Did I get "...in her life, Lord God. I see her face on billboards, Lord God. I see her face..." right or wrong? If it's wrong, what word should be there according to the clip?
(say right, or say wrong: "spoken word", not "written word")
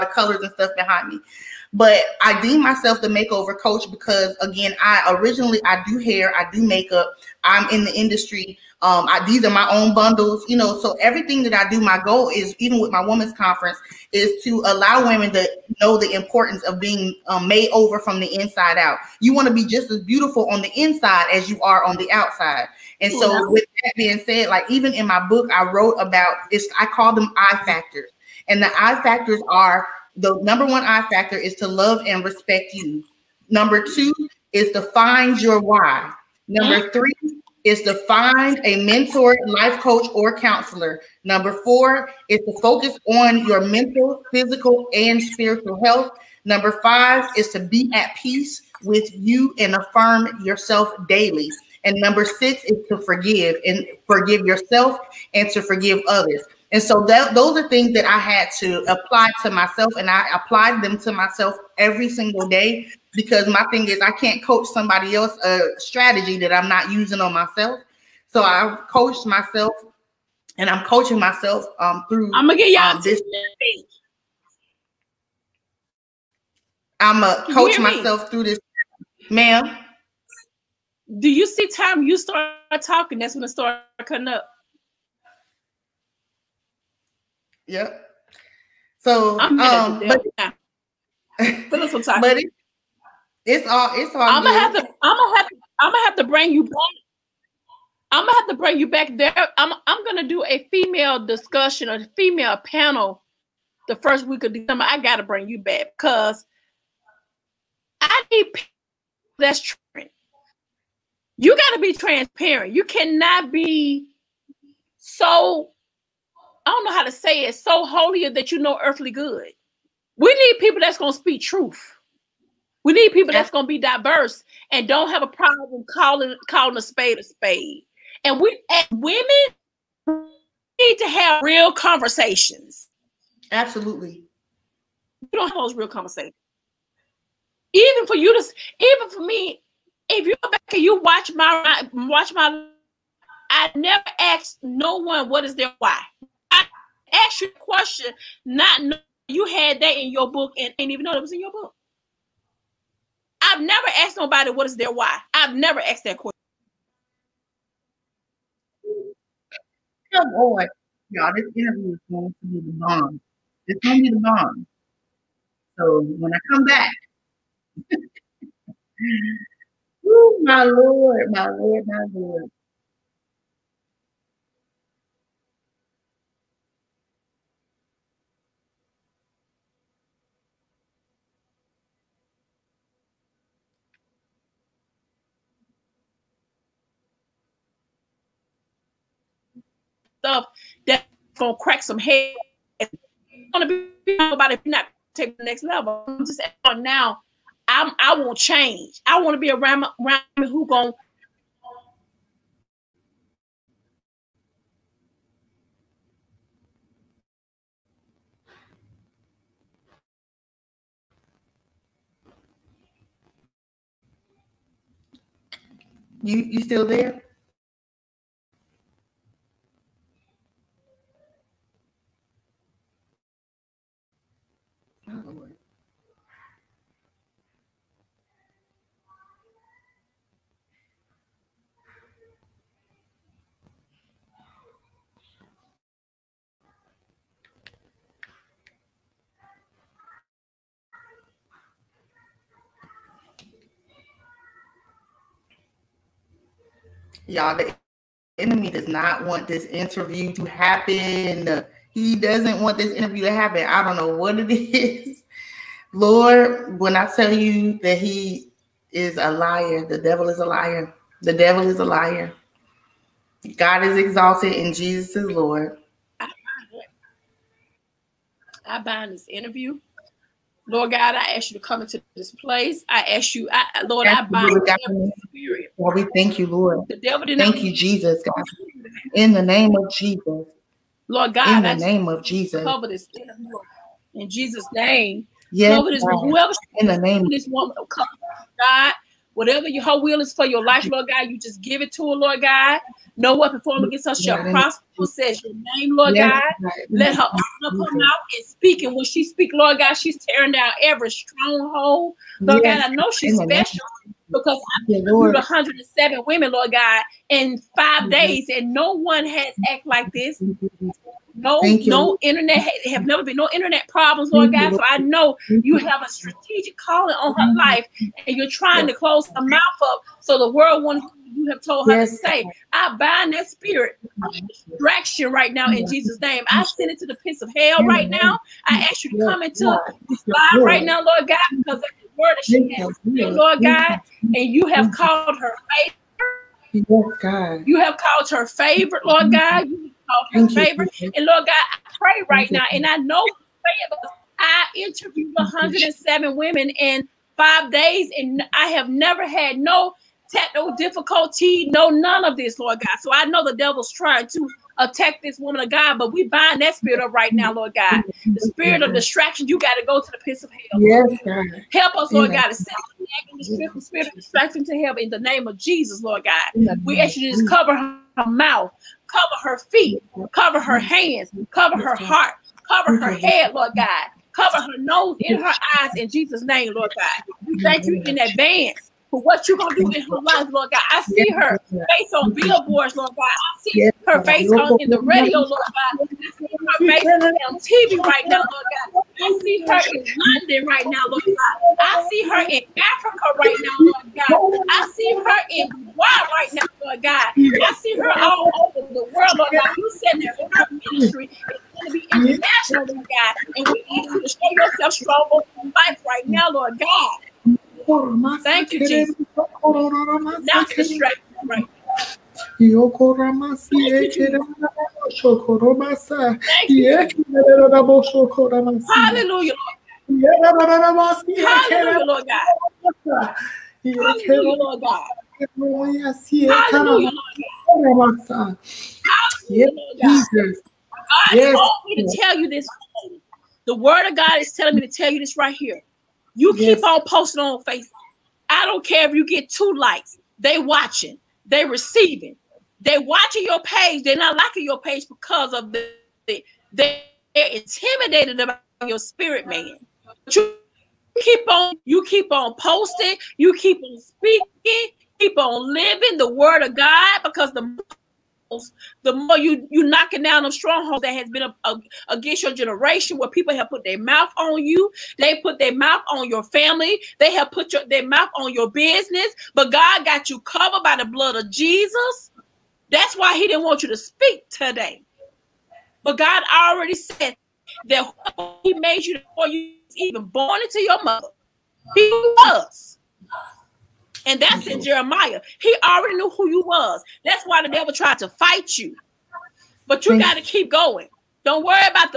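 right.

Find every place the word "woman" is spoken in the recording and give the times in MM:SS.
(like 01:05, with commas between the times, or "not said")
04:47, 05:55.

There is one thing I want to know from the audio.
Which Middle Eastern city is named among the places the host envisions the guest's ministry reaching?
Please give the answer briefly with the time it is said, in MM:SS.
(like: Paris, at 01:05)
Dubai, at 06:35.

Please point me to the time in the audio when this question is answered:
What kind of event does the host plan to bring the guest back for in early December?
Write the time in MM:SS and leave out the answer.
01:41.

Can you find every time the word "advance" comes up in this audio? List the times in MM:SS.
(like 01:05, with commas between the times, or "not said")
06:18.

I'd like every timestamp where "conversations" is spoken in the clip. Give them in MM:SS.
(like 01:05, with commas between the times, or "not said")
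02:11, 02:15.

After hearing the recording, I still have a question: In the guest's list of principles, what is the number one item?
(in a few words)
Love and respect you.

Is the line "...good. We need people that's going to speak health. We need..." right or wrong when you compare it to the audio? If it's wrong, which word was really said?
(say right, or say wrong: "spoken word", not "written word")
wrong: "truth", not "health".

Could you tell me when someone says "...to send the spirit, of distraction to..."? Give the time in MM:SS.
06:02.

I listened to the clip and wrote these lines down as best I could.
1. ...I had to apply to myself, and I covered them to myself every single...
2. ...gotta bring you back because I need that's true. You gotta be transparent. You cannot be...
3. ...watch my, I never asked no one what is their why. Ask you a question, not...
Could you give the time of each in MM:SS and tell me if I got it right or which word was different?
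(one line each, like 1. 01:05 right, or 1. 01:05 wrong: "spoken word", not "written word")
1. 00:58 wrong: "applied", not "covered"
2. 01:44 right
3. 02:21 right.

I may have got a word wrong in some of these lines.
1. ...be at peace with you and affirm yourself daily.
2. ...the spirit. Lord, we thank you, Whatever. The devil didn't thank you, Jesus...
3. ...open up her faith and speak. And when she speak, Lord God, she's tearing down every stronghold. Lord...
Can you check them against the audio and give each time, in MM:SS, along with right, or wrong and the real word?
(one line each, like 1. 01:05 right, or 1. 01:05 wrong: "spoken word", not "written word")
1. 00:47 right
2. 04:34 wrong: "Lord", not "Whatever"
3. 04:57 wrong: "mouth", not "faith".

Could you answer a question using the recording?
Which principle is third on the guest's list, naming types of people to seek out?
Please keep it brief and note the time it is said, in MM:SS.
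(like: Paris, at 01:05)
Find a mentor, life coach, or counselor, at 00:38.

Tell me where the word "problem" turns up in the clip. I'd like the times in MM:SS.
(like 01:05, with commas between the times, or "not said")
02:05, 05:13.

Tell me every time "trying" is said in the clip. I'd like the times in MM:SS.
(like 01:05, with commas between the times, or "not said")
05:18, 05:53.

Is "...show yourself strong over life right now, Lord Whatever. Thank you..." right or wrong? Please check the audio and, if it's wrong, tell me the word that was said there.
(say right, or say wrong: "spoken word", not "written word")
wrong: "God", not "Whatever".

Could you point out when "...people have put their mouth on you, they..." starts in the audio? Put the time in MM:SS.
07:43.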